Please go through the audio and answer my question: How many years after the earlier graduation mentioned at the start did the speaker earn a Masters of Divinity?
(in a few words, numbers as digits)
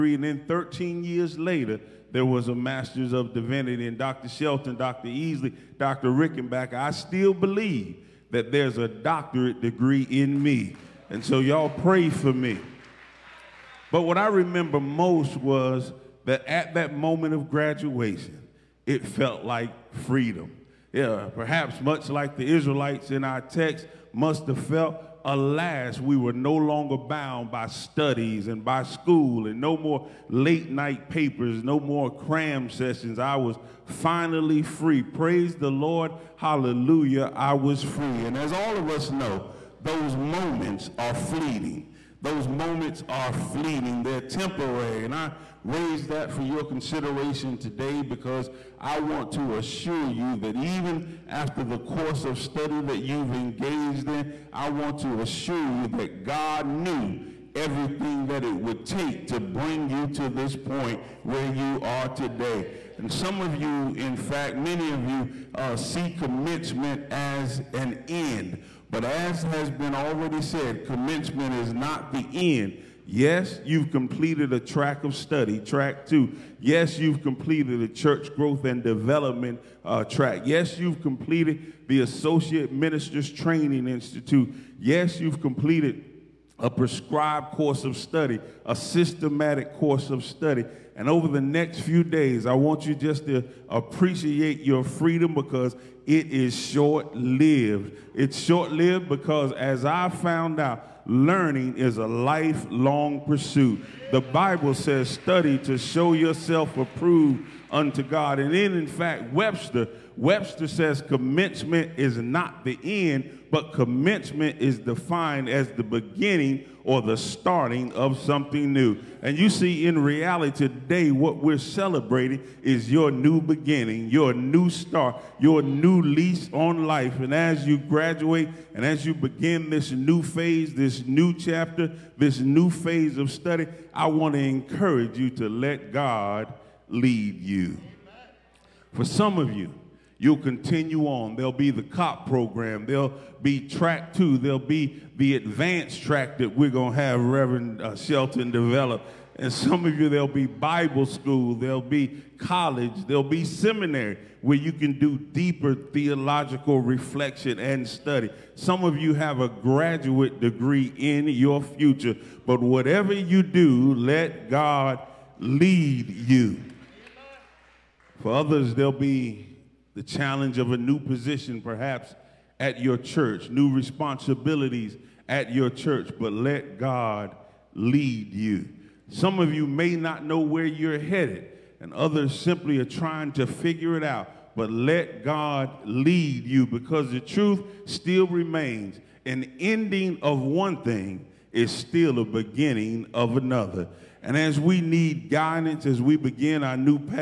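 13.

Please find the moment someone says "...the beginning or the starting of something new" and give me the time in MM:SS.
01:55.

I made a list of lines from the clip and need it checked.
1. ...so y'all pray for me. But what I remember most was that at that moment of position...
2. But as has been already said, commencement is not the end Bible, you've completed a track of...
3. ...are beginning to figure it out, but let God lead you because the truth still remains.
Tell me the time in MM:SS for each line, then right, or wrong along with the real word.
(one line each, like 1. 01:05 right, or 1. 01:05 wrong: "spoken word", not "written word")
1. 00:11 wrong: "graduation", not "position"
2. 01:08 wrong: "Yes", not "Bible"
3. 03:02 wrong: "trying", not "beginning".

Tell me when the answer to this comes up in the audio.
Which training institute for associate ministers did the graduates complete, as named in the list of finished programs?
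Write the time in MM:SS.
01:22.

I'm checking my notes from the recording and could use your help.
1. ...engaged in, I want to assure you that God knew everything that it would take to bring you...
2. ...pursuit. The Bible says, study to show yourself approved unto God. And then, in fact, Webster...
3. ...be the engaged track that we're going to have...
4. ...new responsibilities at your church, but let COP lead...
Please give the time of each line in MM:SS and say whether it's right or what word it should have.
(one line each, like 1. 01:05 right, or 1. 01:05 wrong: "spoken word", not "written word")
1. 00:53 right
2. 01:43 right
3. 02:24 wrong: "advanced", not "engaged"
4. 02:53 wrong: "God", not "COP".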